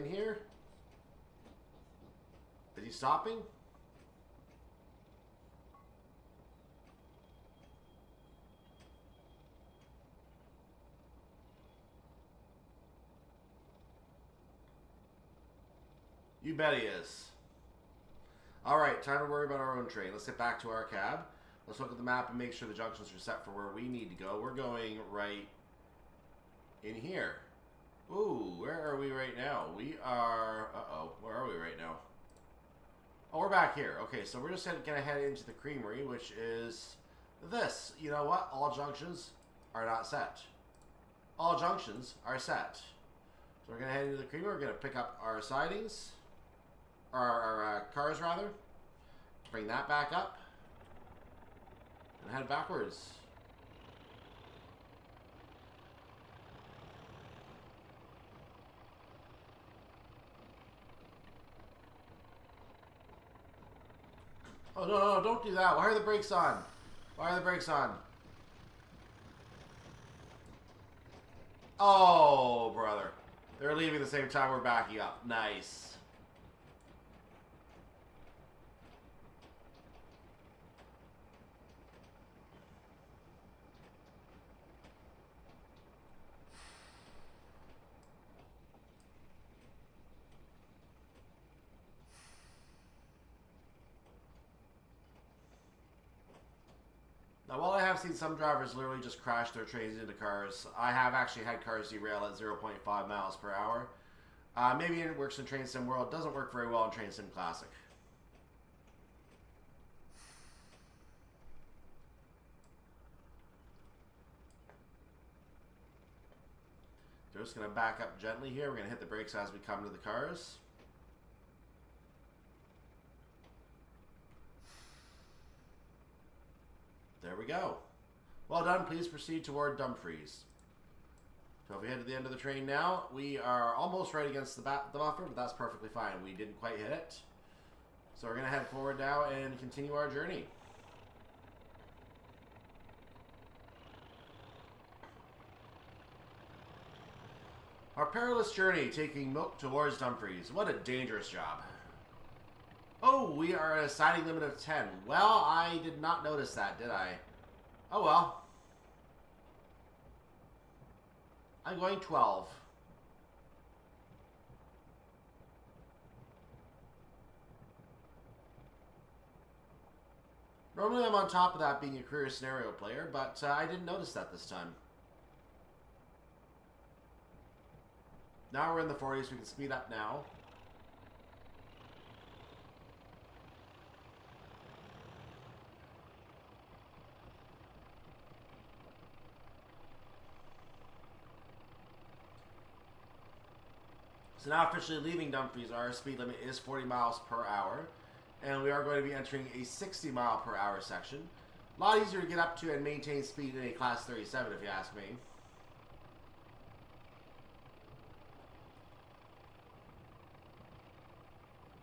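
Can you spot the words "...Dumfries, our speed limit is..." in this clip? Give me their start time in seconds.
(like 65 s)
195 s.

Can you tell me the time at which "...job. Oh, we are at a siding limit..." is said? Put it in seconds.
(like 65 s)
151 s.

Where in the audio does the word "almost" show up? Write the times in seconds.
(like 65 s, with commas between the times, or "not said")
133 s.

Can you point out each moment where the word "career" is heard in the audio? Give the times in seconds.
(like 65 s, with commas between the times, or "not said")
172 s.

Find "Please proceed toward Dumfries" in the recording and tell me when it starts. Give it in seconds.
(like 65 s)
128 s.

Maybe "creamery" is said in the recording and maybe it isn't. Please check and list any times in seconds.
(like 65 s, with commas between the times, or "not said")
35 s, 44 s.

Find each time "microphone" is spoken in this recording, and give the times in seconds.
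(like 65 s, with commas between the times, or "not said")
not said.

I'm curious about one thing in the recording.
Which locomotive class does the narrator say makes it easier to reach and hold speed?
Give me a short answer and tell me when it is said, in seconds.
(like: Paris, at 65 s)
Class 37, at 203 s.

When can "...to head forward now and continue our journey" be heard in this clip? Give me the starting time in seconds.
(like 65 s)
138 s.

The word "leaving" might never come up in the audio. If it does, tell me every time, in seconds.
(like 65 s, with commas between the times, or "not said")
73 s, 194 s.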